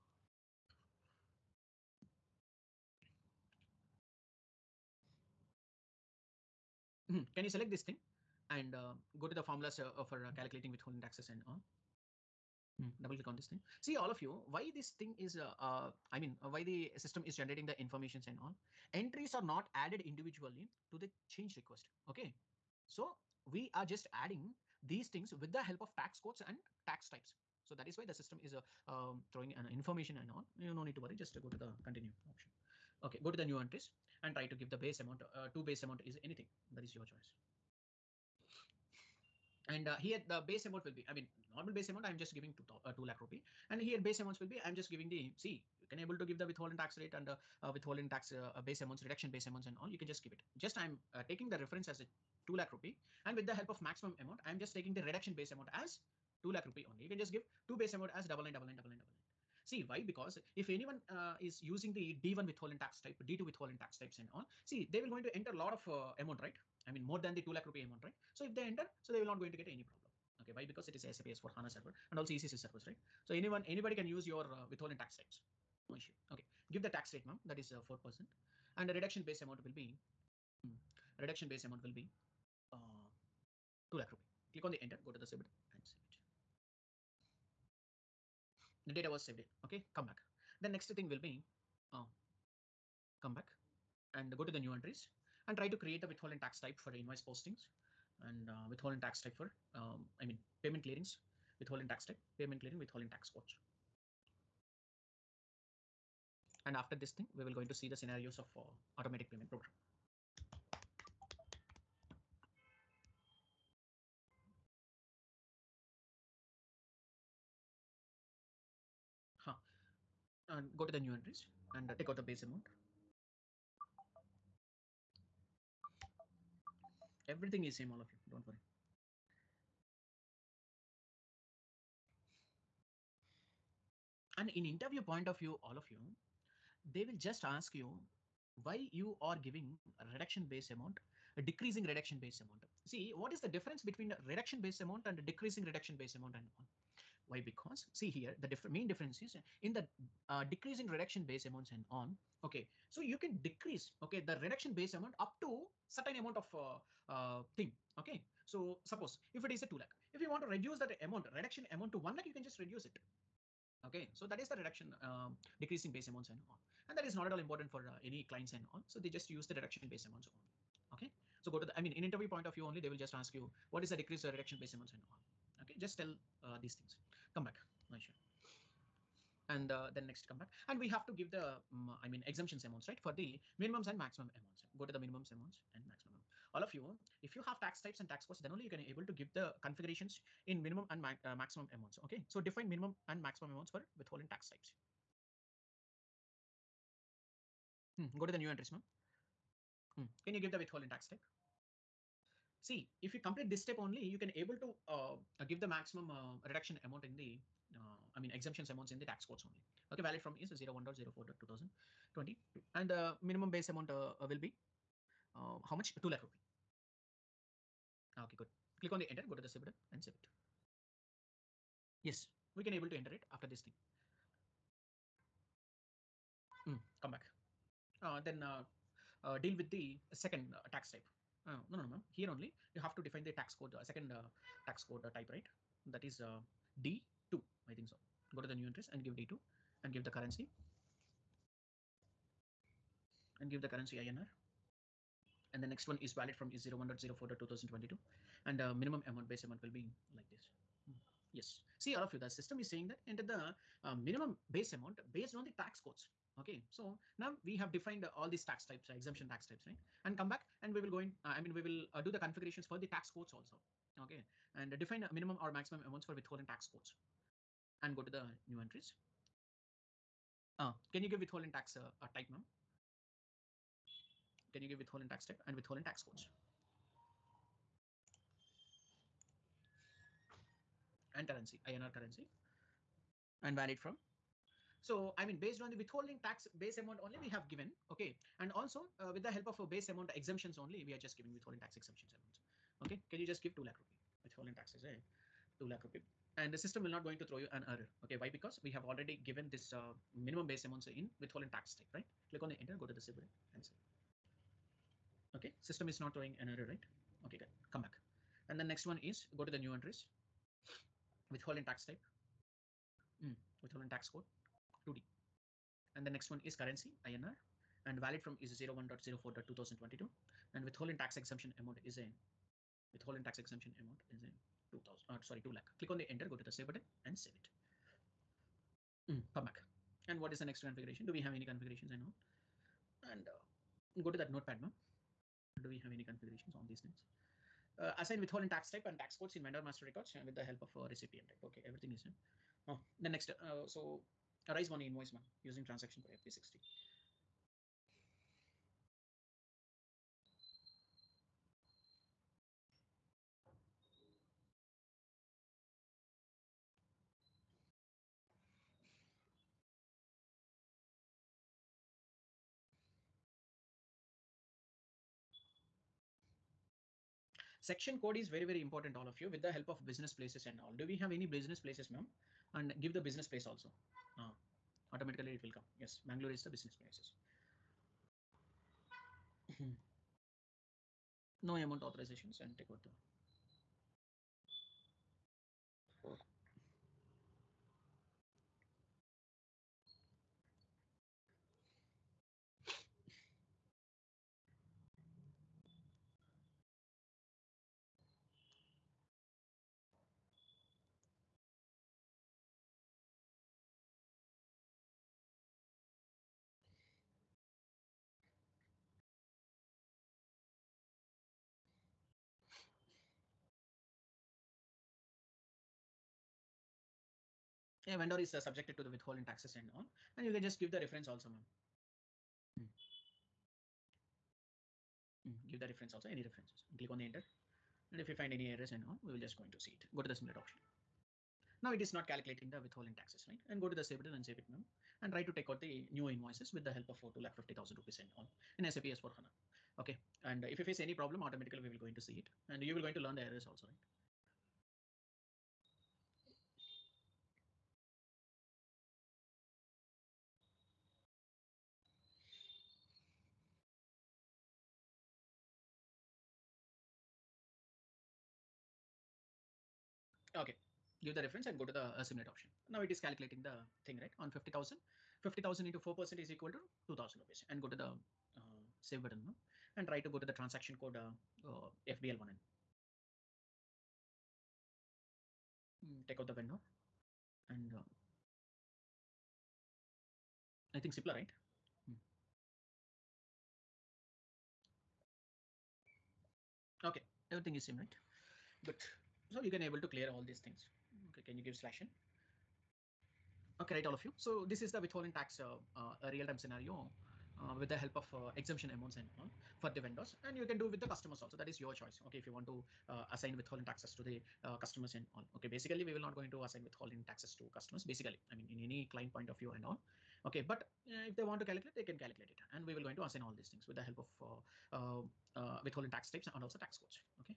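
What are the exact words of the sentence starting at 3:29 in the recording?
Okay, valid from is 01.04.2022 and the uh, minimum base amount uh, will be how much?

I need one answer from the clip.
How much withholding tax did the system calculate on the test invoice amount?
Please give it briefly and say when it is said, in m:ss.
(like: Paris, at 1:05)
2000 rupees, at 7:46.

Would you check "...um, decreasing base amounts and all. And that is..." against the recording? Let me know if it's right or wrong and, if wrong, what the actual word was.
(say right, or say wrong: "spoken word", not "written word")
right.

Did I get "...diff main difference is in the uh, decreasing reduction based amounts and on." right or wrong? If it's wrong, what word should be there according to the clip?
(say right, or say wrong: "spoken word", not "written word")
right.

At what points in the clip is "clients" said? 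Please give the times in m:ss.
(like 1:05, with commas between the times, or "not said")
2:48, 8:28.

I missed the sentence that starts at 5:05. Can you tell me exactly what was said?
Okay, system is not throwing an error, right?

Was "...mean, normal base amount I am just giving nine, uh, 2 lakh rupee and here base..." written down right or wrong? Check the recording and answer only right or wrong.
wrong.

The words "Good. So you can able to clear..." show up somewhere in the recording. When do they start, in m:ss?
8:08.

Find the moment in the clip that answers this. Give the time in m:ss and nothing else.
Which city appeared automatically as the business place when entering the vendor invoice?
6:16.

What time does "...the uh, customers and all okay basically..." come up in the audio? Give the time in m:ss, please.
8:24.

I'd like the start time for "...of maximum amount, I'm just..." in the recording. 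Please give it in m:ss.
0:53.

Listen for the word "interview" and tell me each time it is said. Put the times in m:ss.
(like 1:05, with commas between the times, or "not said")
2:14, 2:52.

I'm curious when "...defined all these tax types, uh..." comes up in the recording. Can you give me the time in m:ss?
4:17.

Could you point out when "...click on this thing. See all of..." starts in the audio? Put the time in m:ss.
0:13.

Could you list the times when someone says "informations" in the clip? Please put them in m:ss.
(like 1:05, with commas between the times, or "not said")
0:17, 0:29.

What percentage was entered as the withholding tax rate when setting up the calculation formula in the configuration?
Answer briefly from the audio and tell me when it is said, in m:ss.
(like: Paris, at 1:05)
4%, at 1:17.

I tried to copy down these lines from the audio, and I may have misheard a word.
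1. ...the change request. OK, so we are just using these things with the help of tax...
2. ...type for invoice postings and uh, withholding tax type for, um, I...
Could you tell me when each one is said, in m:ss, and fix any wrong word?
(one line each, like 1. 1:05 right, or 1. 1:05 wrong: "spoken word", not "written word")
1. 0:21 wrong: "adding", not "using"
2. 1:36 right.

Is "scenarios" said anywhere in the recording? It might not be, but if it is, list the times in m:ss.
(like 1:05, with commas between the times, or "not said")
1:47, 8:16.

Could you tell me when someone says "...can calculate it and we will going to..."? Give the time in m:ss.
8:31.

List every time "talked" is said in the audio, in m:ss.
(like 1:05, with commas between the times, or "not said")
not said.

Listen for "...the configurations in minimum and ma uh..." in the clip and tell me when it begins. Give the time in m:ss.
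3:09.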